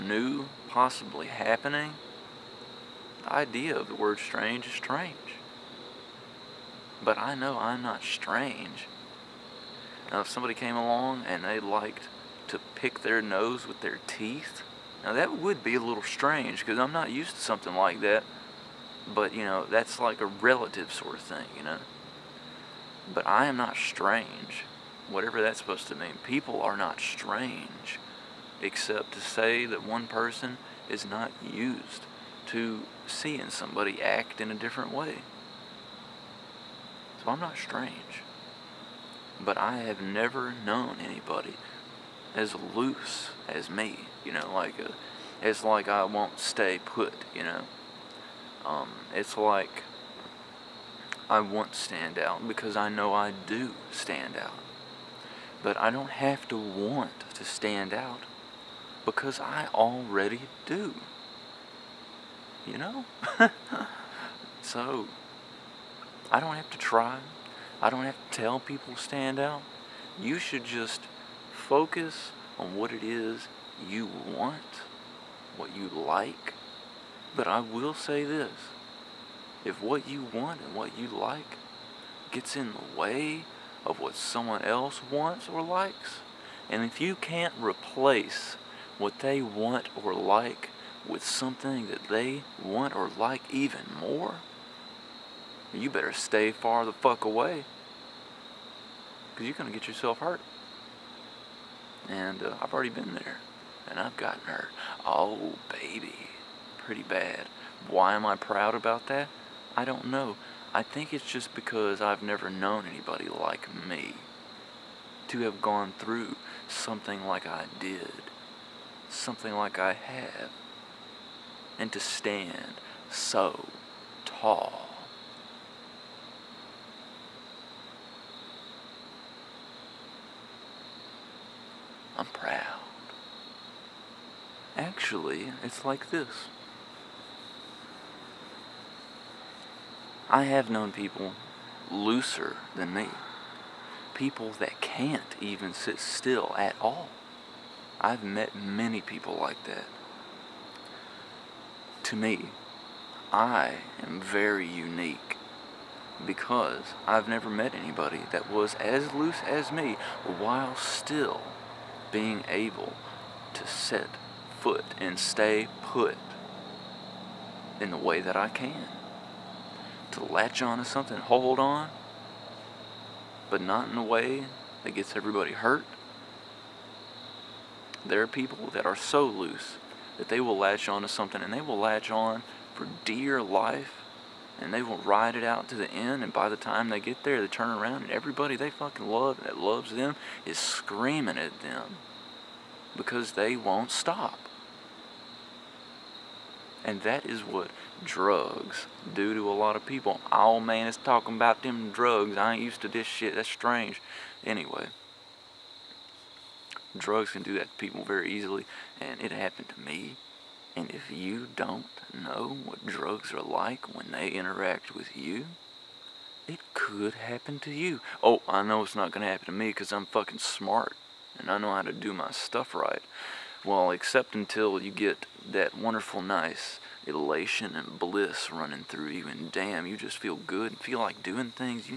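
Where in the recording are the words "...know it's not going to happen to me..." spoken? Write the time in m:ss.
3:38.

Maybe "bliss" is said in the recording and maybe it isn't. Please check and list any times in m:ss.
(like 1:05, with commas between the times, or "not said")
3:47.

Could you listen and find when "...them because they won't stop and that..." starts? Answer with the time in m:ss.
3:11.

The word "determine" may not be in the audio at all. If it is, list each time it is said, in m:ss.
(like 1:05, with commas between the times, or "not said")
not said.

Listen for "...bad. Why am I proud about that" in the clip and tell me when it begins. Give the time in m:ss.
1:47.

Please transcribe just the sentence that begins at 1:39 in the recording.
Because you're going to get yourself hurt.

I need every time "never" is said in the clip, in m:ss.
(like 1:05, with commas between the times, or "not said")
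0:40, 1:52, 2:37.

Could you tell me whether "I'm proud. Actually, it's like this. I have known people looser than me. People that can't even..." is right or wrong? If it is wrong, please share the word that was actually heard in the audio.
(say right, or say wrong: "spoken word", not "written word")
right.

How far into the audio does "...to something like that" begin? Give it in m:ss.
0:17.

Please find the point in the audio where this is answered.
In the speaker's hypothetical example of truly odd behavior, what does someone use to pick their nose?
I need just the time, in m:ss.
0:13.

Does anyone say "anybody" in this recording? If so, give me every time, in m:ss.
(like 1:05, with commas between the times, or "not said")
0:40, 1:52, 2:37.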